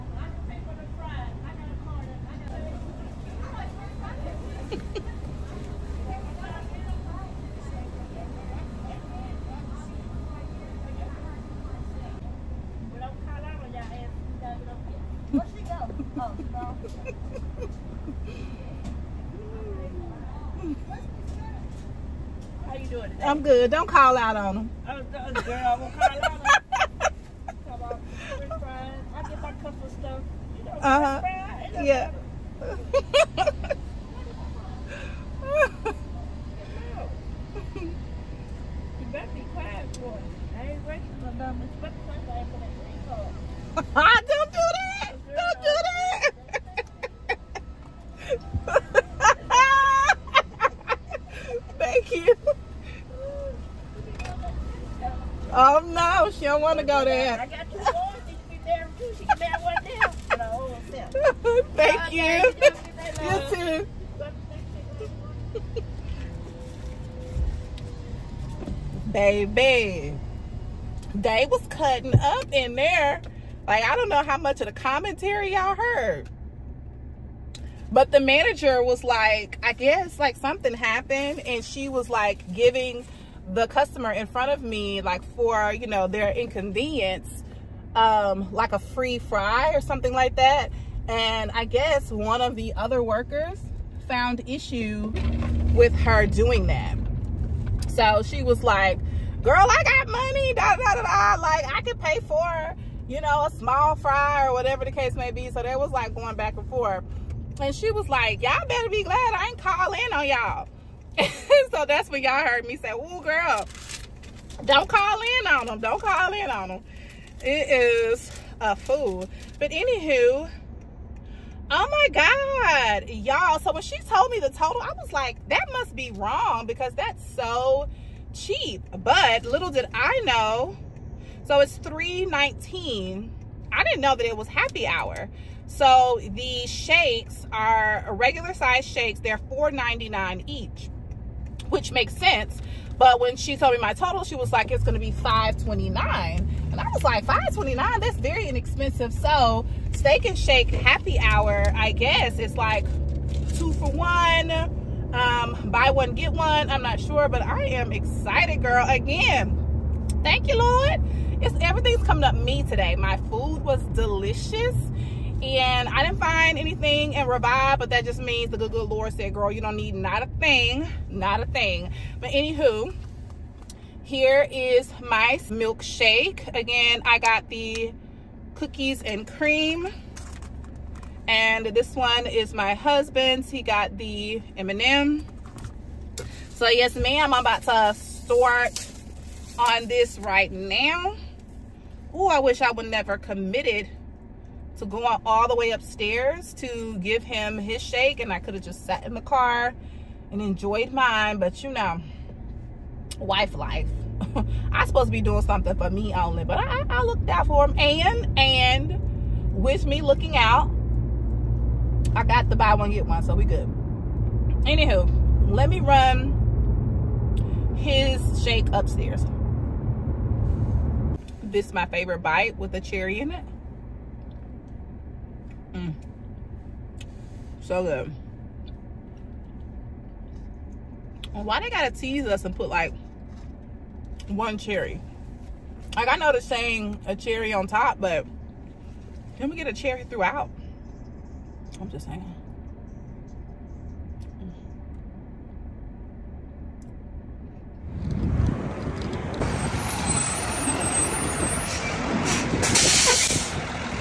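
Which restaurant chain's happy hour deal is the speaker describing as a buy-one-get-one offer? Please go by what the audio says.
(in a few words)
Steak and Shake.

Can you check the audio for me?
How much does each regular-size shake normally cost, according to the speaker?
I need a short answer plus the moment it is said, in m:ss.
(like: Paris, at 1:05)
$4.99, at 2:19.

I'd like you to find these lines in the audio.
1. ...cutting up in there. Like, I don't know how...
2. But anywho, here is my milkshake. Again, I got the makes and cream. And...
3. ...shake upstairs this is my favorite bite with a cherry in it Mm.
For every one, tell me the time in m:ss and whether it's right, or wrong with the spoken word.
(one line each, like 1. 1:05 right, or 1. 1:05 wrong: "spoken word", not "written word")
1. 1:11 right
2. 2:52 wrong: "cookies", not "makes"
3. 3:38 right.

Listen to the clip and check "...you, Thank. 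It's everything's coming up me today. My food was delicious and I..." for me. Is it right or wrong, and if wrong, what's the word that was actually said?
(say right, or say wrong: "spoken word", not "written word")
wrong: "Lord", not "Thank".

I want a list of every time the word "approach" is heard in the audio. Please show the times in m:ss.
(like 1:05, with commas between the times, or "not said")
not said.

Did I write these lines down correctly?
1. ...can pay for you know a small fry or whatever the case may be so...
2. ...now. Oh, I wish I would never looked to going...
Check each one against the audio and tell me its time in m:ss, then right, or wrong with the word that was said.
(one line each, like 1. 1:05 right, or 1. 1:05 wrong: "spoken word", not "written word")
1. 1:41 right
2. 3:10 wrong: "committed", not "looked".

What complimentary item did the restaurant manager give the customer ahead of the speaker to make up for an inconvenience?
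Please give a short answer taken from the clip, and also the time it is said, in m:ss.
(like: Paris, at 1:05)
a free fry, at 1:28.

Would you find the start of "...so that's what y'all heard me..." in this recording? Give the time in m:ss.
1:51.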